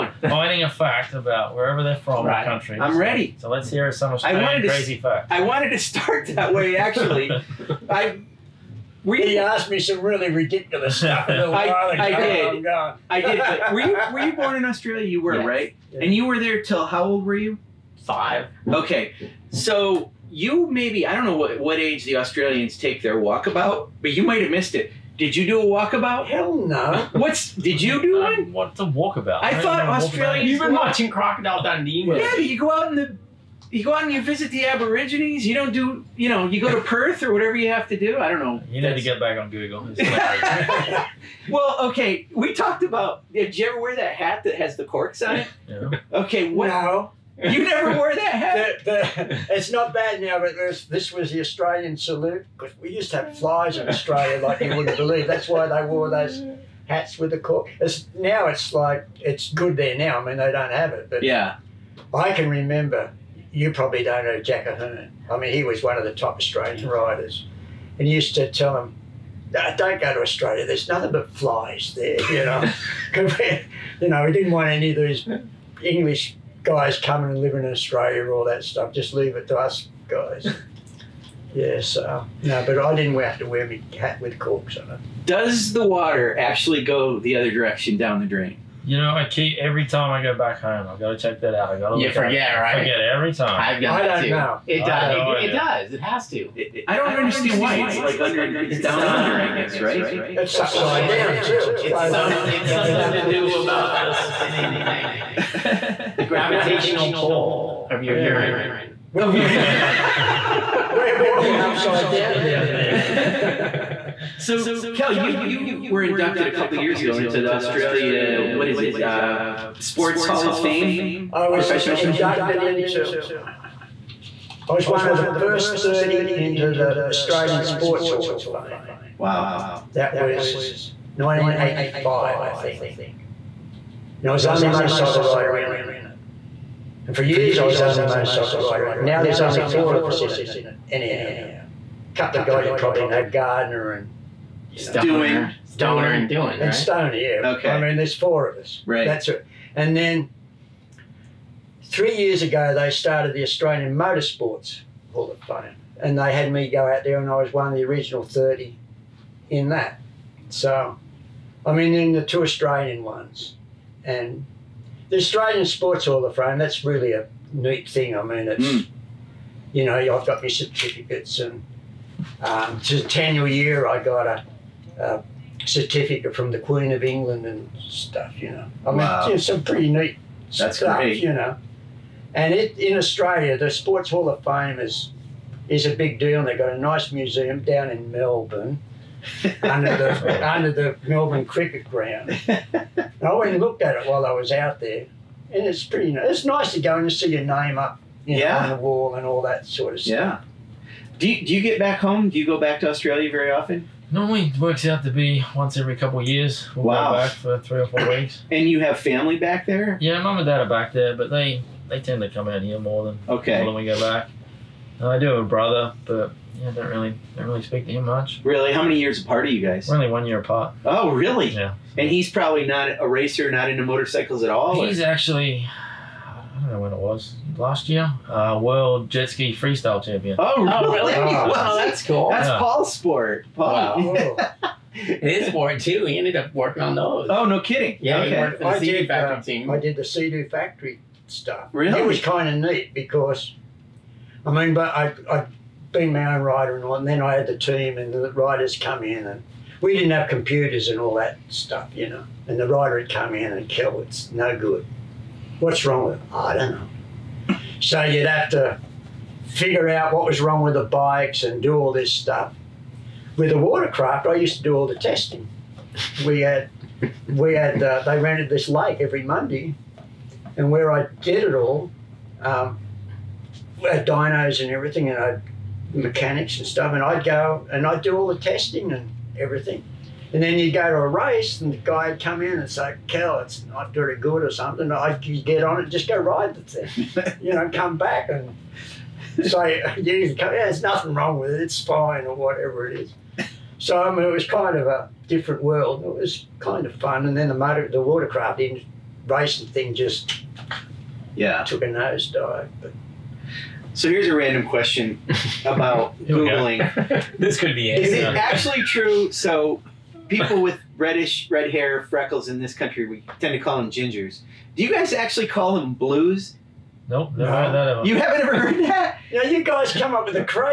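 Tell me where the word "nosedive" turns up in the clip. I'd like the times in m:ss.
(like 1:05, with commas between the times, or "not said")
5:01.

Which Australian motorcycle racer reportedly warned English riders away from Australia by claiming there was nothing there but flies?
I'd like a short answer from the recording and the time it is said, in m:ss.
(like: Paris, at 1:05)
Jack Ahearn, at 1:04.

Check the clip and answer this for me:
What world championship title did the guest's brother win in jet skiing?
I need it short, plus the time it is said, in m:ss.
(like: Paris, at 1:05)
freestyle champion, at 3:49.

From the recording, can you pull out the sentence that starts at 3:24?
Normally it works out to be once every couple of years.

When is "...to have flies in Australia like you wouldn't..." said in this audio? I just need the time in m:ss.
0:53.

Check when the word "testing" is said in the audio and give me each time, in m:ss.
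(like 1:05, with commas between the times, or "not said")
4:24, 4:38.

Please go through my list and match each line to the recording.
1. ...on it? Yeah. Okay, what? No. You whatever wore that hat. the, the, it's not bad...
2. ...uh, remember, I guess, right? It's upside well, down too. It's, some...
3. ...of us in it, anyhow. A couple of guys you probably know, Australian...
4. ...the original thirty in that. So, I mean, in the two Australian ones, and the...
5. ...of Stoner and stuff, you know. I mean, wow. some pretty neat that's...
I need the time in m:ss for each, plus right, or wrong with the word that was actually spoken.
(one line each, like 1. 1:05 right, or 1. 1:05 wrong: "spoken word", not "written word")
1. 0:45 wrong: "never", not "whatever"
2. 1:38 wrong: "under", not "remember"
3. 2:19 wrong: "Gardner", not "Australian"
4. 2:37 right
5. 2:56 wrong: "England", not "Stoner".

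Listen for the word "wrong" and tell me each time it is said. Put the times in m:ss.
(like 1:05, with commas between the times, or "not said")
4:15, 4:20, 4:51.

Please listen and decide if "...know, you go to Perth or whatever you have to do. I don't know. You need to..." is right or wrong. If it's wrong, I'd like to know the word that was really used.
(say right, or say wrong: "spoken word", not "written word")
right.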